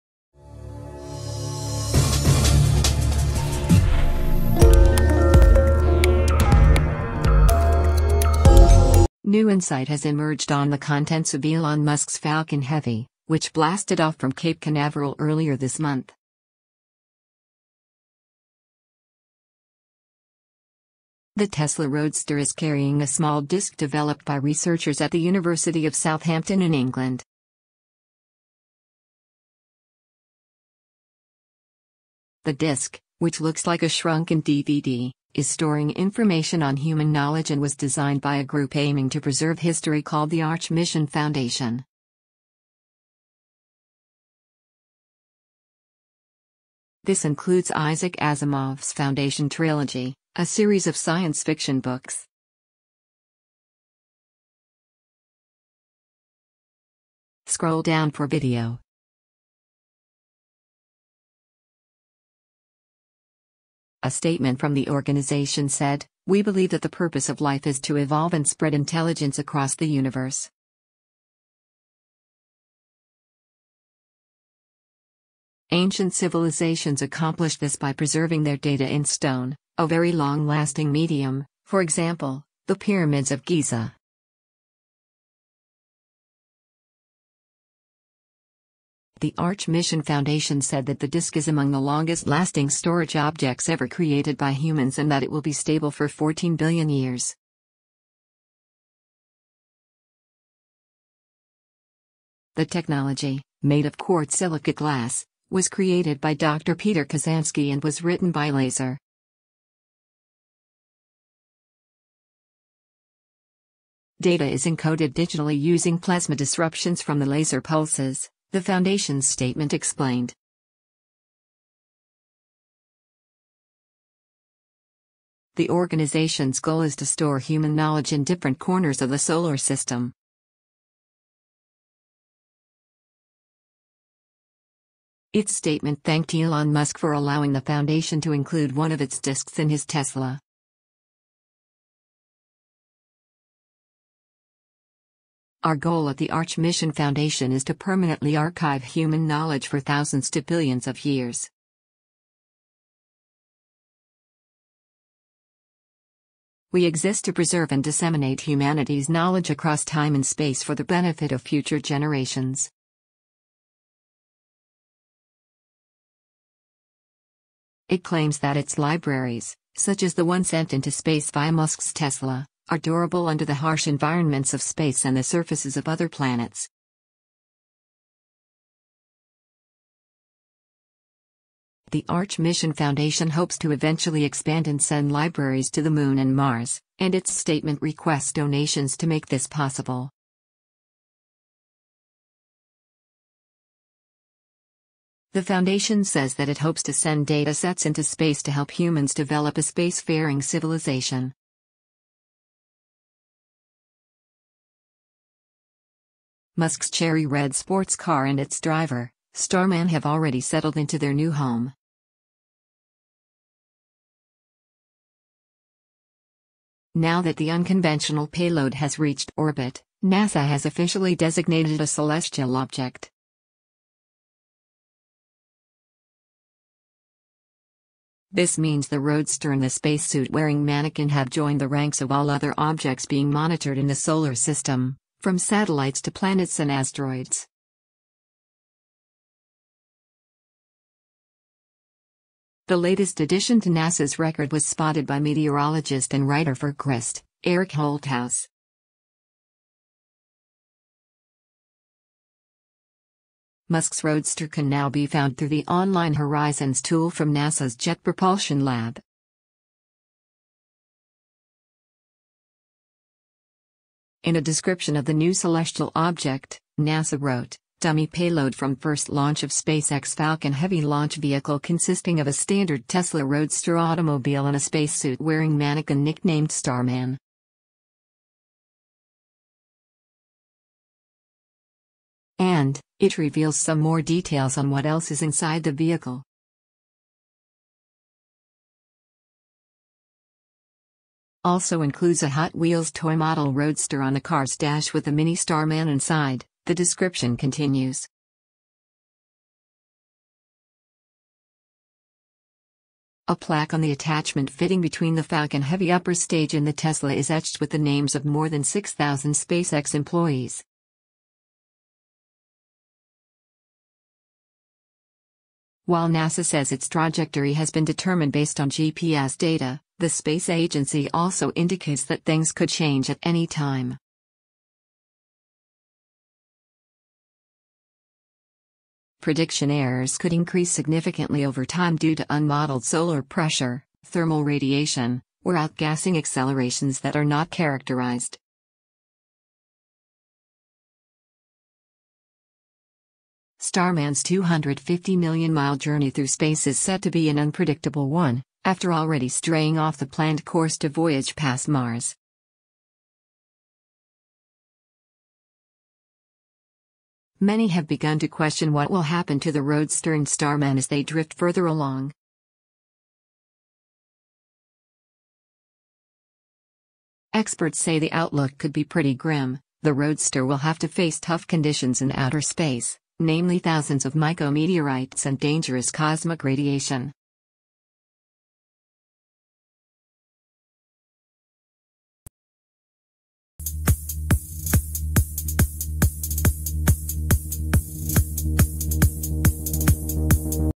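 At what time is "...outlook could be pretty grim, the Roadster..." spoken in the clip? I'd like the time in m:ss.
6:08.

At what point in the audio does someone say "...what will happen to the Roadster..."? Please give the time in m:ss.
5:58.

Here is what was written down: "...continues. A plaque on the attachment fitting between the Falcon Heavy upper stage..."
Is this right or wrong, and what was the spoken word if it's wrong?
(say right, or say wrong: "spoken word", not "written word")
right.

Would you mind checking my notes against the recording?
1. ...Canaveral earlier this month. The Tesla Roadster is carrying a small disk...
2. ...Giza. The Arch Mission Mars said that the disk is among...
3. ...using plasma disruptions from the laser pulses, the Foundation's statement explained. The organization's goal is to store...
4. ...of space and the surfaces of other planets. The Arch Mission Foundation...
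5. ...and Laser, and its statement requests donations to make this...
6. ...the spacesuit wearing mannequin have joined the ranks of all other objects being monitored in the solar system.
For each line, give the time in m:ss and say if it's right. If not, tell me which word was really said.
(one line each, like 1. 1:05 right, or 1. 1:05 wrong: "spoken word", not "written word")
1. 0:14 right
2. 1:23 wrong: "Foundation", not "Mars"
3. 1:55 right
4. 2:54 right
5. 3:06 wrong: "Mars", not "Laser"
6. 3:49 right.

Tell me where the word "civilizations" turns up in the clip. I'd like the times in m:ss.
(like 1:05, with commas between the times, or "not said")
1:16, 3:20.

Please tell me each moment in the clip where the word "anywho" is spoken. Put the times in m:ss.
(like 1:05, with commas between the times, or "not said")
not said.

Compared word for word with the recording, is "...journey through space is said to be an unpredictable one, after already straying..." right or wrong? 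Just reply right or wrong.
right.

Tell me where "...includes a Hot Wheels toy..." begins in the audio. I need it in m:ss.
4:51.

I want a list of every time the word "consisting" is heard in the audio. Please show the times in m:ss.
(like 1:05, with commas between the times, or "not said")
4:31.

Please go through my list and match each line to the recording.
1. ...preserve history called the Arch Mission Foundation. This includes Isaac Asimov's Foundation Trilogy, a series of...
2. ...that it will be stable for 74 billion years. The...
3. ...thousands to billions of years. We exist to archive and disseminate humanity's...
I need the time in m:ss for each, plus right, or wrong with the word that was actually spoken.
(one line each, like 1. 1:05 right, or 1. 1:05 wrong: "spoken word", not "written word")
1. 0:39 right
2. 1:35 wrong: "14", not "74"
3. 2:29 wrong: "preserve", not "archive".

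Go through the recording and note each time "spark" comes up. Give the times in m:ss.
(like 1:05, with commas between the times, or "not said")
not said.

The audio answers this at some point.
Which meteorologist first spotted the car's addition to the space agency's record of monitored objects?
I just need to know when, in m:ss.
4:07.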